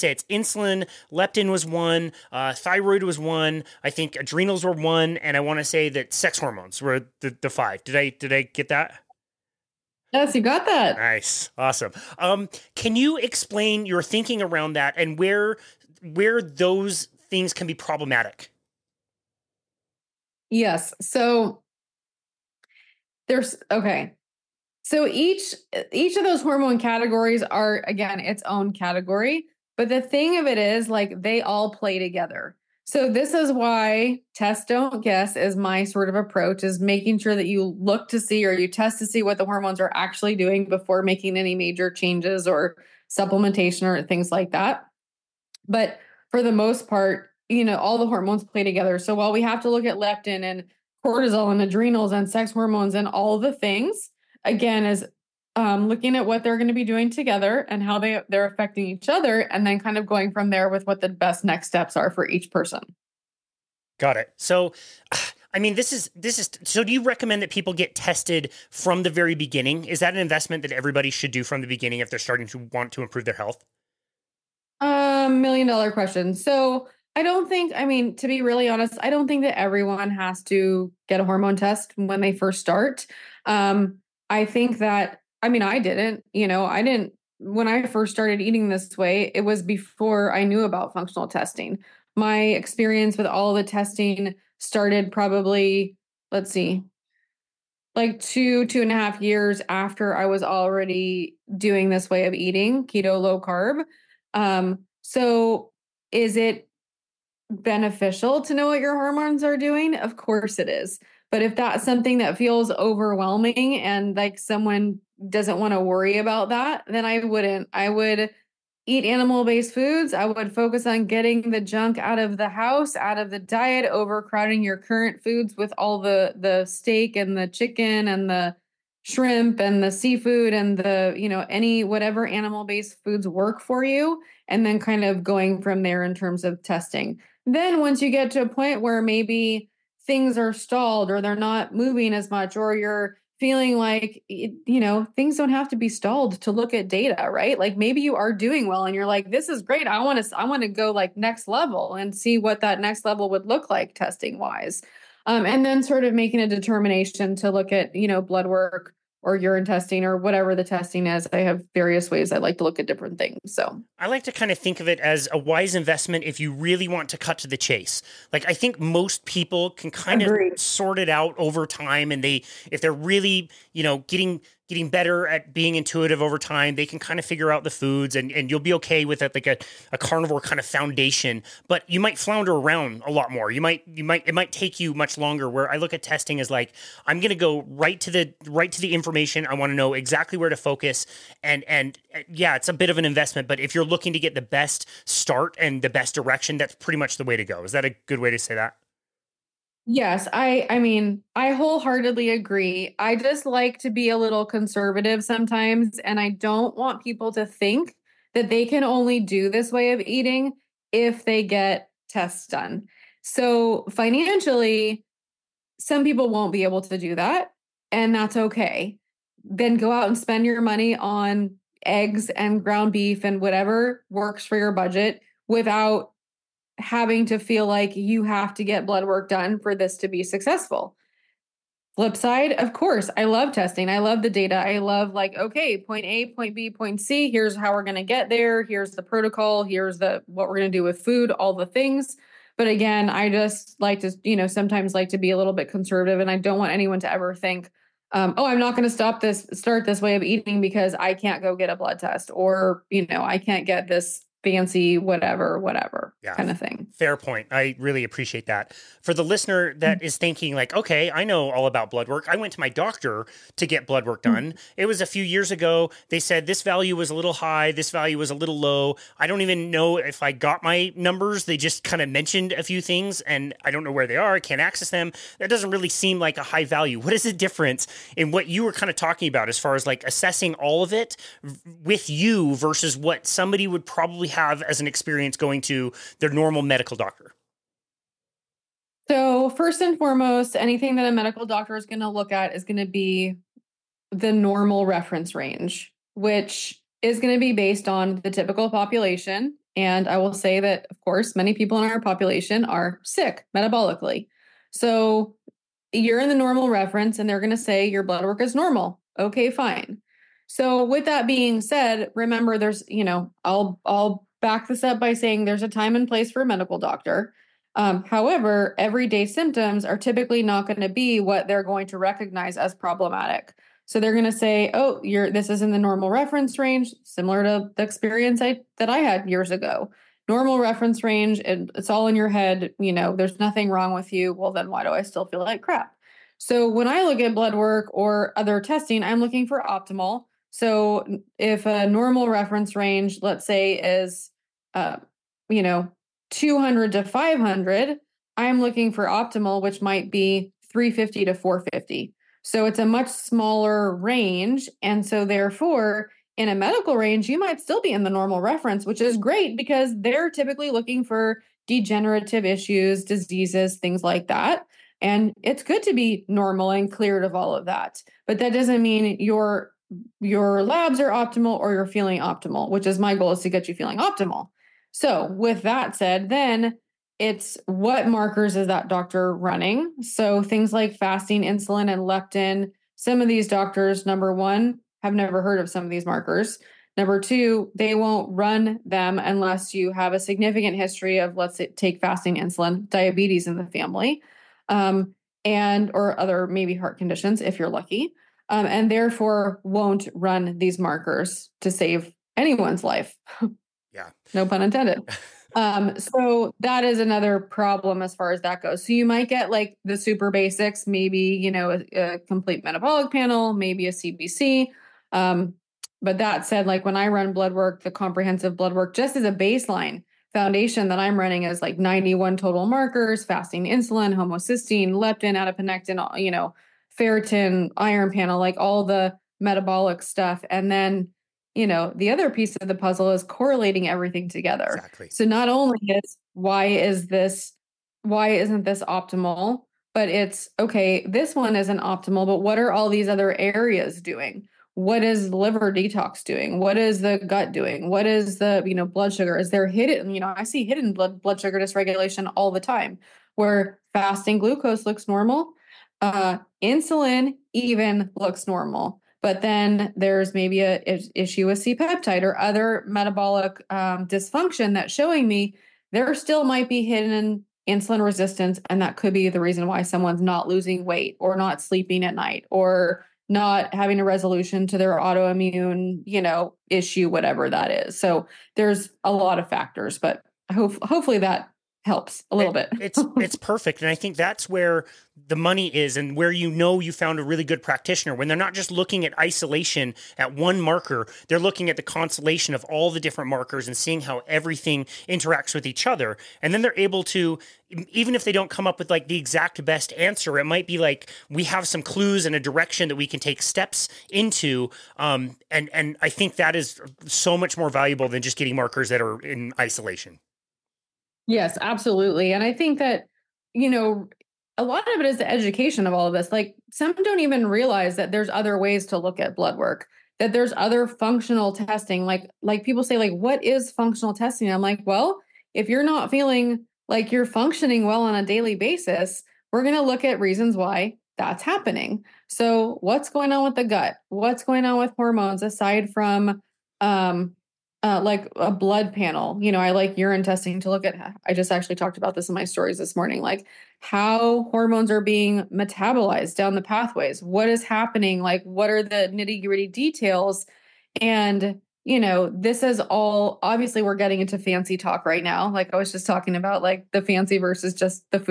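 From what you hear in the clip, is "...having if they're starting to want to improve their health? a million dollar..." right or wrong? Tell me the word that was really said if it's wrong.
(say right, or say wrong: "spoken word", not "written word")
wrong: "beginning", not "having".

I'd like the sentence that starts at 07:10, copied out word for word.
And then, you know, the other piece of the puzzle is correlating everything together.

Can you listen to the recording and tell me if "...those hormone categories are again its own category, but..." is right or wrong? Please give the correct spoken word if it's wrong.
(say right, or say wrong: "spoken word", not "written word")
right.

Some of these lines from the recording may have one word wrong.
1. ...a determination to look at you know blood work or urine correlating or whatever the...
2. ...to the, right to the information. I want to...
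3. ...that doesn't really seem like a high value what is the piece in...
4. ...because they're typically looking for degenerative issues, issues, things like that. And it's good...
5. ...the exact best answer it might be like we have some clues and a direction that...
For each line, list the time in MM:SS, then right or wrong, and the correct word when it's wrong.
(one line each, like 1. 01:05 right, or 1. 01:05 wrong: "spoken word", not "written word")
1. 02:36 wrong: "testing", not "correlating"
2. 03:07 right
3. 04:35 wrong: "difference", not "piece"
4. 05:59 wrong: "diseases", not "issues"
5. 08:19 right.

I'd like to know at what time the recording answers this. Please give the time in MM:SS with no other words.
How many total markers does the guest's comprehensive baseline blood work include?
07:01.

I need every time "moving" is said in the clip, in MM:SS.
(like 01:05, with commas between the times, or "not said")
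02:21.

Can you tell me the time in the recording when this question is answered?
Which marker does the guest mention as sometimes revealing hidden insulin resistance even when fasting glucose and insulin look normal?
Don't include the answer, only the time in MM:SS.
07:41.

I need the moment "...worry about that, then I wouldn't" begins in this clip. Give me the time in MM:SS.
01:55.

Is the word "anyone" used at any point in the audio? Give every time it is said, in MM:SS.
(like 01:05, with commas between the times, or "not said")
04:06, 06:42.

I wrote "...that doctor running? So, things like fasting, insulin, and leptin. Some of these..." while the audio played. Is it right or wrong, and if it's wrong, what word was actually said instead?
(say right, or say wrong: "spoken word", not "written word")
right.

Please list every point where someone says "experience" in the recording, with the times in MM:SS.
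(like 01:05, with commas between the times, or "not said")
01:32, 04:44, 05:27.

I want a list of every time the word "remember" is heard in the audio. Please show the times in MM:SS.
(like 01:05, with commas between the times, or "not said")
05:12.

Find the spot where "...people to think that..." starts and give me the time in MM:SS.
03:27.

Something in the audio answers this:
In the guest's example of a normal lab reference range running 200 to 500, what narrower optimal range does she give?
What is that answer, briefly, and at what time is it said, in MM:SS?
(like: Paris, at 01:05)
350 to 450, at 05:50.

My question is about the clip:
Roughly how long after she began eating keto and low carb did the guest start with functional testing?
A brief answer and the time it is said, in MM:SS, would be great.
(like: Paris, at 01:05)
2 to 2.5 years, at 01:38.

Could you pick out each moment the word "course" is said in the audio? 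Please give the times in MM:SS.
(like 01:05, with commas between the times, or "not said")
01:50, 03:52, 05:01.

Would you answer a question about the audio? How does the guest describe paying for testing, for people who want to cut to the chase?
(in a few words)
A wise investment.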